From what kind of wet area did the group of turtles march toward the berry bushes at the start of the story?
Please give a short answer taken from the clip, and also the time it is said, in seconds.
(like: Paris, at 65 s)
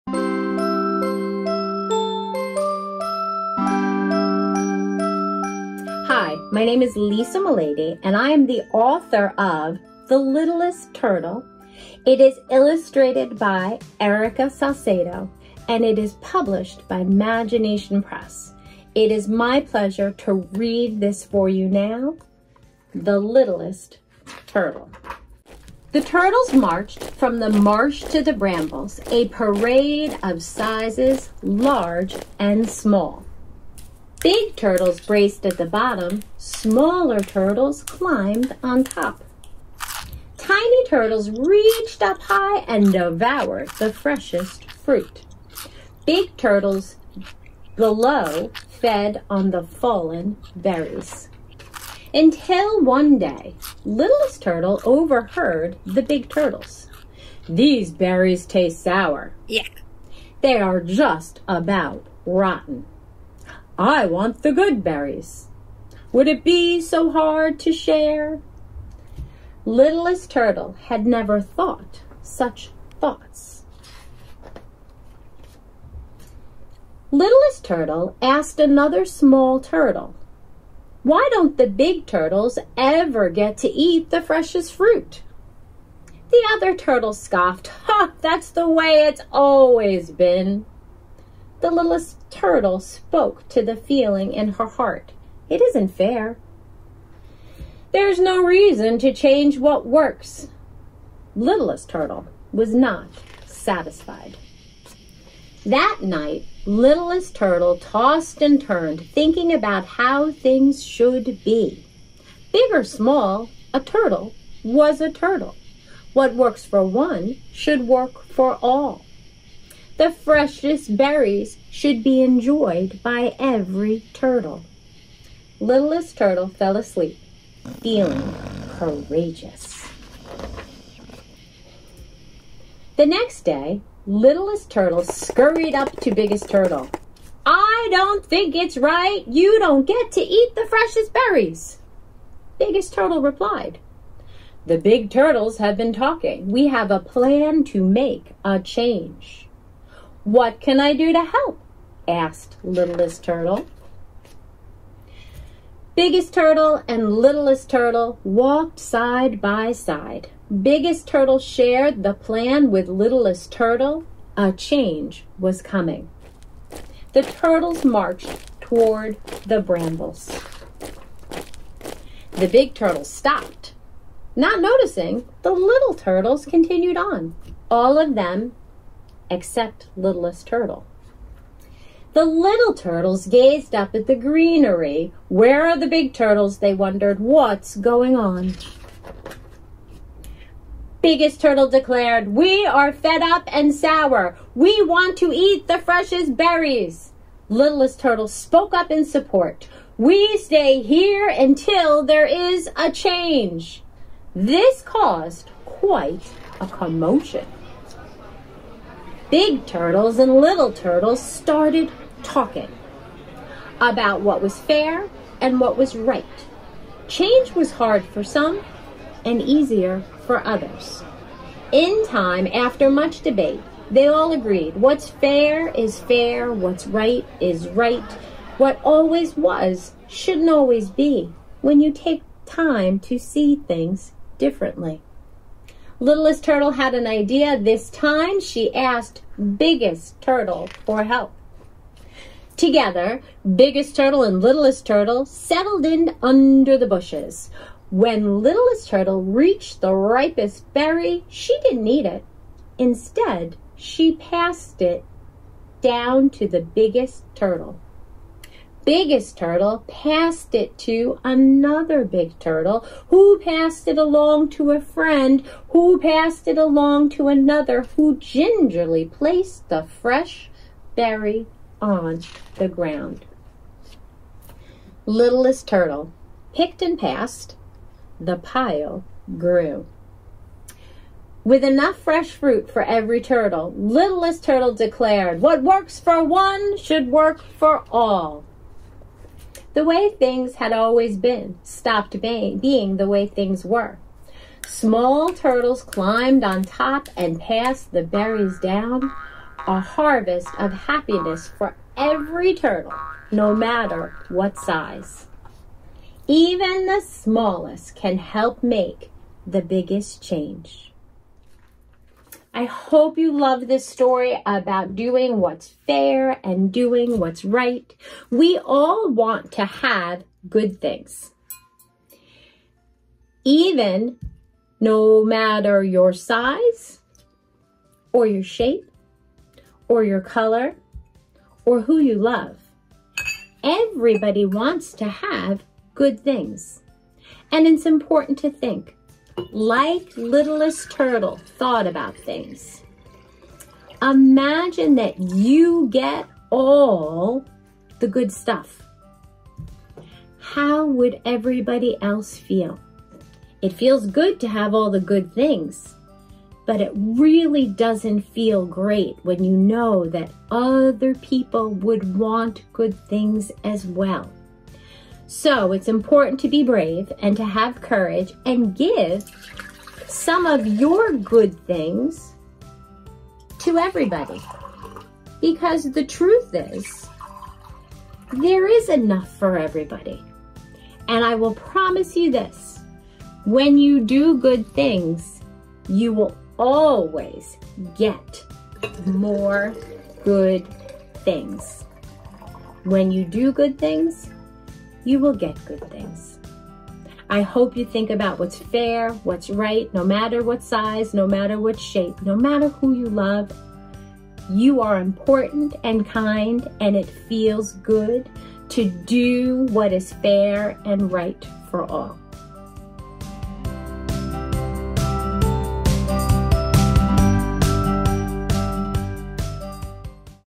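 the marsh, at 27 s.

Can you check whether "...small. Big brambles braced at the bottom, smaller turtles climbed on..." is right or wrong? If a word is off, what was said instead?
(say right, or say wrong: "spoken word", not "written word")
wrong: "turtles", not "brambles".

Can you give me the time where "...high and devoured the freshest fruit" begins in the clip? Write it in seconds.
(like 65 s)
42 s.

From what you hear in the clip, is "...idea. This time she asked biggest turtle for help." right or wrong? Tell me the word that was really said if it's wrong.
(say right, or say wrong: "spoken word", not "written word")
right.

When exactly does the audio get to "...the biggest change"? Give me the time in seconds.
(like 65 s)
309 s.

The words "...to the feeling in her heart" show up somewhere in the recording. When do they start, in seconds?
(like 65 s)
93 s.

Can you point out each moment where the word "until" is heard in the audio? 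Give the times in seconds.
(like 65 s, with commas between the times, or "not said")
52 s, 201 s.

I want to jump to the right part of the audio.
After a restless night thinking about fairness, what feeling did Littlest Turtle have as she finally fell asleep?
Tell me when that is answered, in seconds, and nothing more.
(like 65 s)
128 s.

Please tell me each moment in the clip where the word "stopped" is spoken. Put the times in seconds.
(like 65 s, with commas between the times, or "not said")
173 s, 291 s.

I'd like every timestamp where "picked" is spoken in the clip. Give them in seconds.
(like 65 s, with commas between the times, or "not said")
276 s.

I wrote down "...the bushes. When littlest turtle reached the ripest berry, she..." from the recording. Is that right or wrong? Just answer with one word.
right.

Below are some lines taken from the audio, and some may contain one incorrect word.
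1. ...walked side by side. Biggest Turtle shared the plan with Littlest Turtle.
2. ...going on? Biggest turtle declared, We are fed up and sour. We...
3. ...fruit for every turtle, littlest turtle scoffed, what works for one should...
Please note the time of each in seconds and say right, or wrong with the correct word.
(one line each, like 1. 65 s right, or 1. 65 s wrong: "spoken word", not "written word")
1. 158 s right
2. 187 s right
3. 282 s wrong: "declared", not "scoffed".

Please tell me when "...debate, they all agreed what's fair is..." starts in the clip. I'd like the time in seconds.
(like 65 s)
223 s.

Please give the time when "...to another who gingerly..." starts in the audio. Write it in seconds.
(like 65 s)
267 s.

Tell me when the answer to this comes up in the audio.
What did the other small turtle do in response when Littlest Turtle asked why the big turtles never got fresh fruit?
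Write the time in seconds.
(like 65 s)
87 s.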